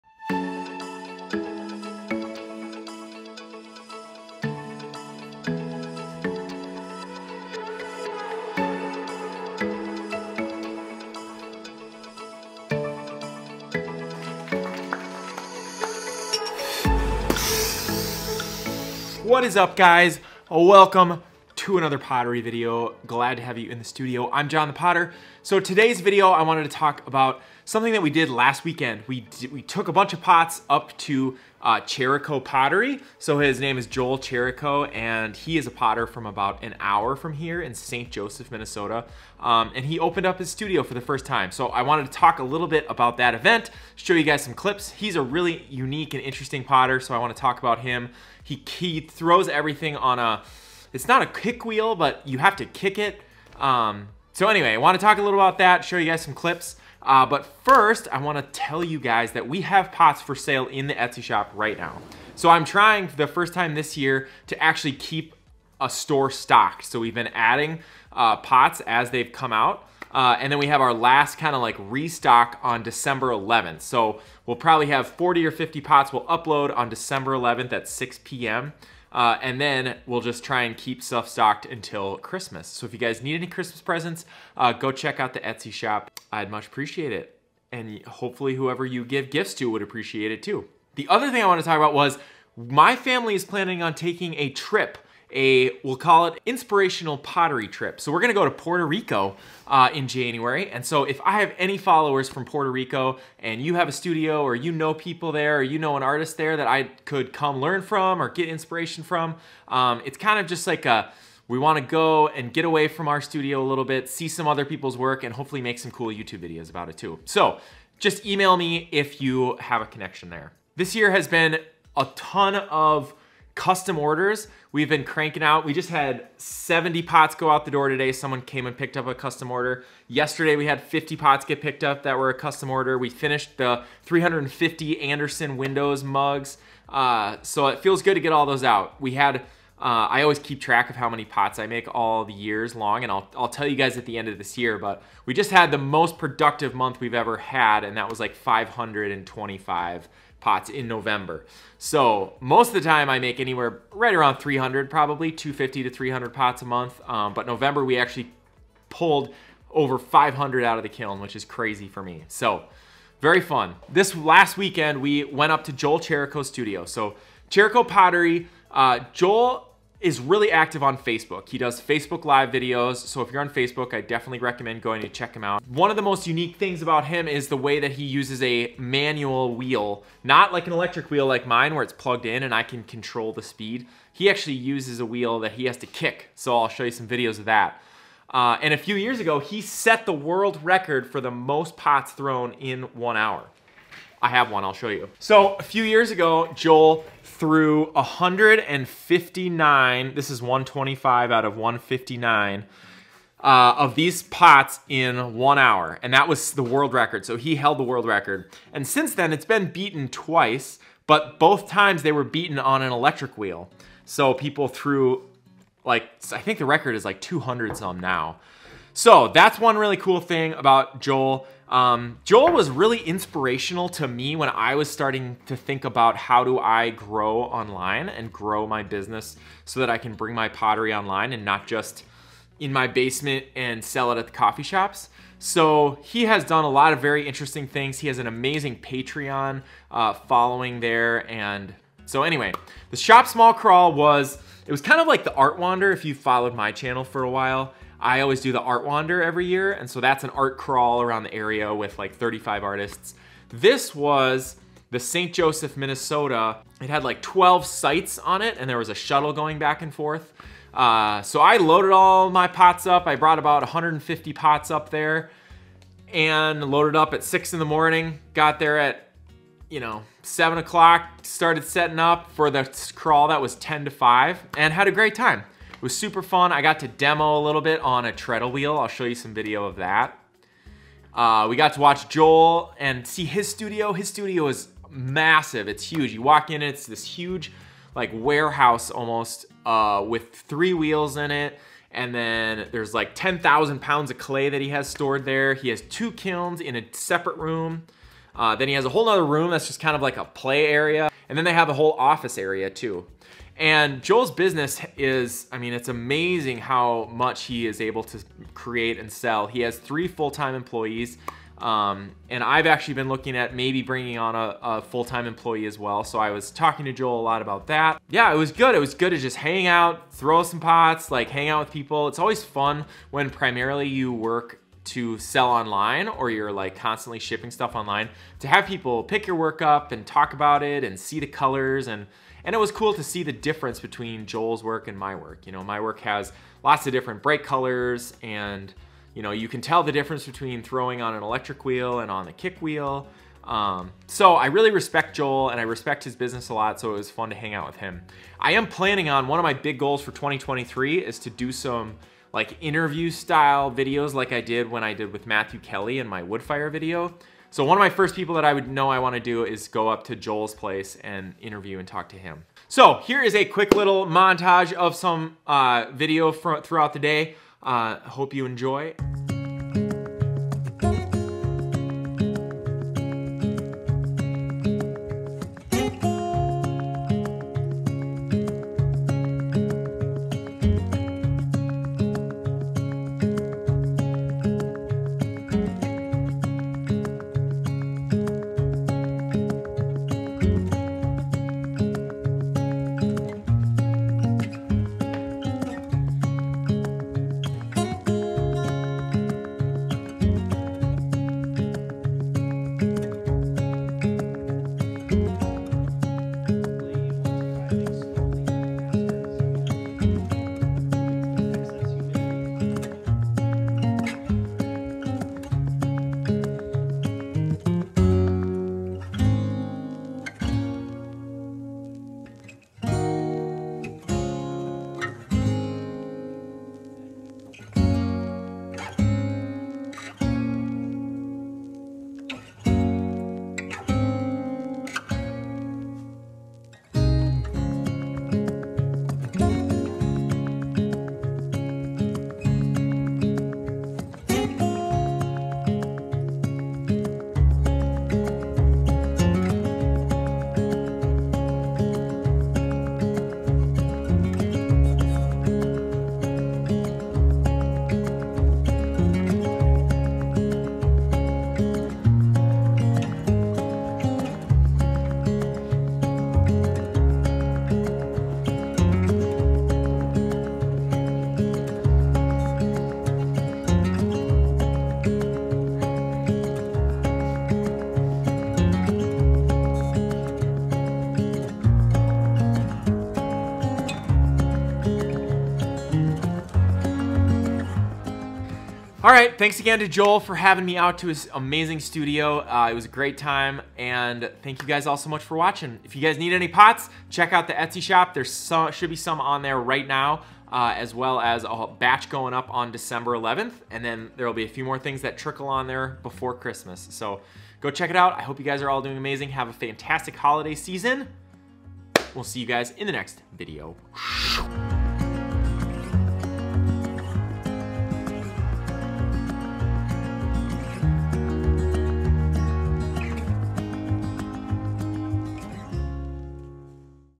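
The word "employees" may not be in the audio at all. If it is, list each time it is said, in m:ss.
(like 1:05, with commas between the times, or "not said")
5:10, 5:15.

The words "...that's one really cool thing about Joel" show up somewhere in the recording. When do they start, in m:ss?
3:39.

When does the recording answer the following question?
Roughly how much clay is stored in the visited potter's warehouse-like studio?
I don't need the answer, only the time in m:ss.
4:53.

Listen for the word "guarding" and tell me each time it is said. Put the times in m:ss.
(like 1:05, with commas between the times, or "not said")
not said.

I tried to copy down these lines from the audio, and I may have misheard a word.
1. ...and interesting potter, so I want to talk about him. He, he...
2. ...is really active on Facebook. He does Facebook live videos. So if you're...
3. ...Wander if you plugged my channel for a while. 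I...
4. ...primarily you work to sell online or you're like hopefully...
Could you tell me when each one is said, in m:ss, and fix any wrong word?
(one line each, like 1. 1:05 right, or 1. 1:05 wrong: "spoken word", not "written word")
1. 0:46 right
2. 2:50 right
3. 4:05 wrong: "followed", not "plugged"
4. 5:23 wrong: "constantly", not "hopefully".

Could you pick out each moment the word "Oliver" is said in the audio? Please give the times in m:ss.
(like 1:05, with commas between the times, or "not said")
not said.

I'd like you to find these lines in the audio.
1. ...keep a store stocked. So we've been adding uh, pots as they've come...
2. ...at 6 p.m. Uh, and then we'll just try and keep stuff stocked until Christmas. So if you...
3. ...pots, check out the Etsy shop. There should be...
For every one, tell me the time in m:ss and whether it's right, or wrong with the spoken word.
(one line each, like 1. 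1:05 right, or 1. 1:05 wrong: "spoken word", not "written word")
1. 1:04 right
2. 1:17 right
3. 8:16 right.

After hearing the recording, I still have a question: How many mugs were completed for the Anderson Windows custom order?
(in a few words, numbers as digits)
350.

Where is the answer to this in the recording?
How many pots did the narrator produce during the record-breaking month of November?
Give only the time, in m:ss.
2:28.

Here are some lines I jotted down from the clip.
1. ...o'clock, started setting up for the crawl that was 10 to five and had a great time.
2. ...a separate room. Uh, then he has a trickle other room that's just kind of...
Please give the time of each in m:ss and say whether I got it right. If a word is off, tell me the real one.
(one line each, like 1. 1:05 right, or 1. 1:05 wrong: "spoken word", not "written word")
1. 4:30 right
2. 4:56 wrong: "whole", not "trickle".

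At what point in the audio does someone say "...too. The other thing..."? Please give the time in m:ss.
1:30.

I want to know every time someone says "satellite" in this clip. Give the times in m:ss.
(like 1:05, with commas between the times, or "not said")
not said.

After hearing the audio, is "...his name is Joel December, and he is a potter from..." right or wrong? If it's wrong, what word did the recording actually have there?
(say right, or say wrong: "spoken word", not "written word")
wrong: "Cherrico", not "December".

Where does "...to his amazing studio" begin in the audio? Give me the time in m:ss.
8:10.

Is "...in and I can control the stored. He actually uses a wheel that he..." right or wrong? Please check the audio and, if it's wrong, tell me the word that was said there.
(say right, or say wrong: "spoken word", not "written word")
wrong: "speed", not "stored".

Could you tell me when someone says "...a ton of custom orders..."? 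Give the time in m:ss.
2:01.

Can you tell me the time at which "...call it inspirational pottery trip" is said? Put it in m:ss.
1:35.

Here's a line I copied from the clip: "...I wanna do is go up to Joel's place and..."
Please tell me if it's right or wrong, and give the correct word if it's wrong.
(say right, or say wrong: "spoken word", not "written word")
right.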